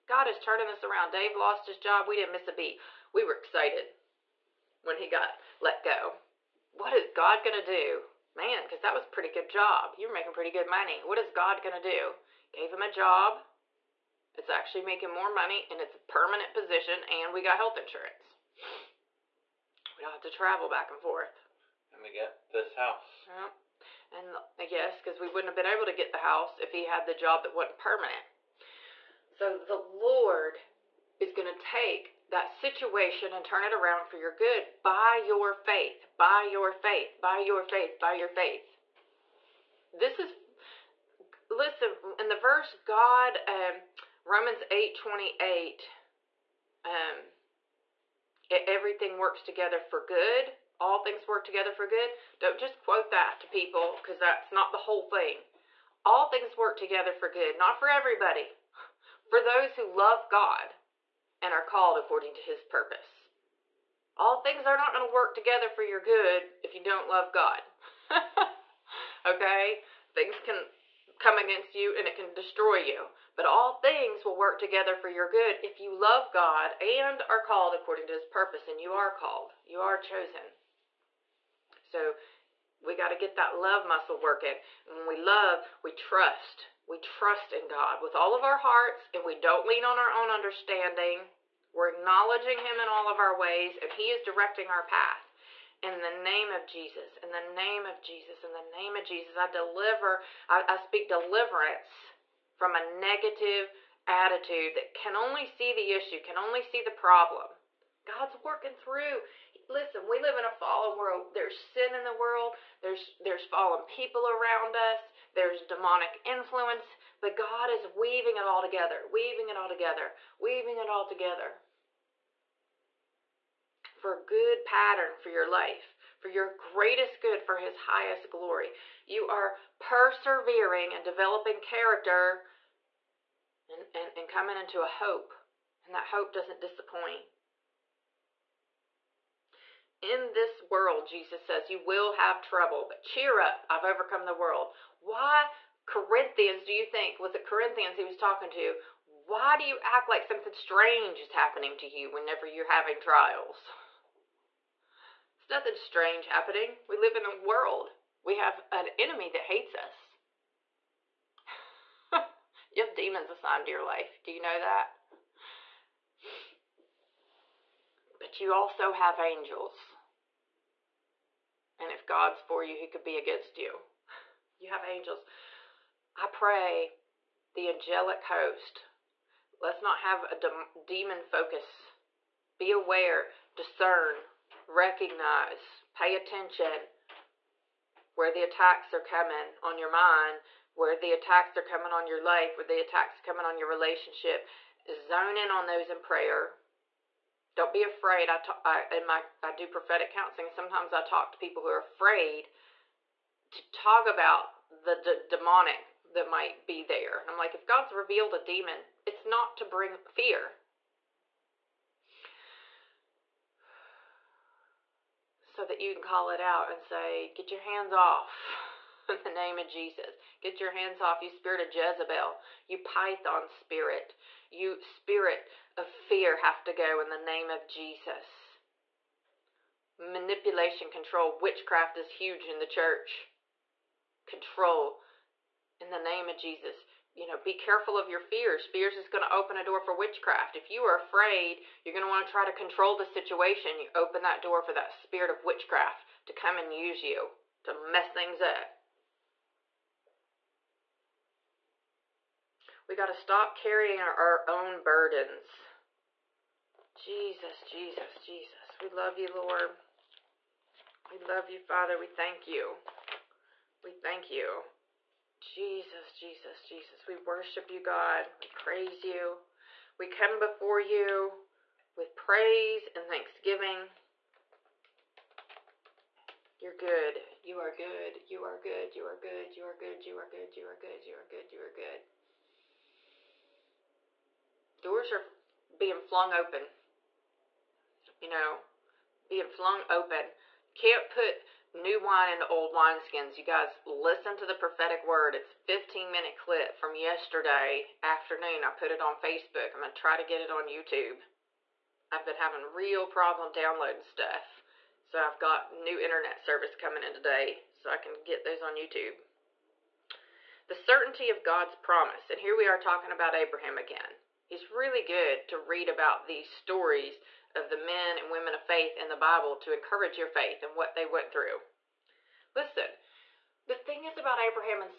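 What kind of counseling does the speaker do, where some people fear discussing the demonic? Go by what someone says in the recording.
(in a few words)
Prophetic counseling.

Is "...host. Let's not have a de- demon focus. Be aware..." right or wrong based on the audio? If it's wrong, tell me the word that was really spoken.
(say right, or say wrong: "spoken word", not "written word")
right.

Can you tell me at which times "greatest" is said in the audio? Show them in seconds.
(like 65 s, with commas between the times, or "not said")
126 s.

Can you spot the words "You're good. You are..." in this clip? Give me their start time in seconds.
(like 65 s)
276 s.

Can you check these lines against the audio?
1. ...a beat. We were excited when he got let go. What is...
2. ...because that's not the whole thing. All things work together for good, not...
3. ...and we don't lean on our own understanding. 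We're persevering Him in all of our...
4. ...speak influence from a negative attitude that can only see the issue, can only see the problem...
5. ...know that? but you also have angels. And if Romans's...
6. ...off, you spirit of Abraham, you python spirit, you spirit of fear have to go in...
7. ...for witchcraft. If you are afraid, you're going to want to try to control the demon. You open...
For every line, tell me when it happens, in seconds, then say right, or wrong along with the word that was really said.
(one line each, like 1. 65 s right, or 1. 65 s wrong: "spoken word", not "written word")
1. 2 s right
2. 54 s right
3. 89 s wrong: "acknowledging", not "persevering"
4. 100 s wrong: "deliverance", not "influence"
5. 164 s wrong: "God", not "Romans"
6. 221 s wrong: "Jezebel", not "Abraham"
7. 239 s wrong: "situation", not "demon".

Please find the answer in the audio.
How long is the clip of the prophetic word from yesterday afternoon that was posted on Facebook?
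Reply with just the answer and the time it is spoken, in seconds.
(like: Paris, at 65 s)
15 minutes, at 295 s.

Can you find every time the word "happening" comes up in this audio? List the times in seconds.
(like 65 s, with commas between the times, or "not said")
151 s, 156 s.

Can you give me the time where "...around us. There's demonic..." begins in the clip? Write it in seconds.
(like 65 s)
114 s.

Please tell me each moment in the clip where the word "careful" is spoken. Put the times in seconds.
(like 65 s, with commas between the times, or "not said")
237 s.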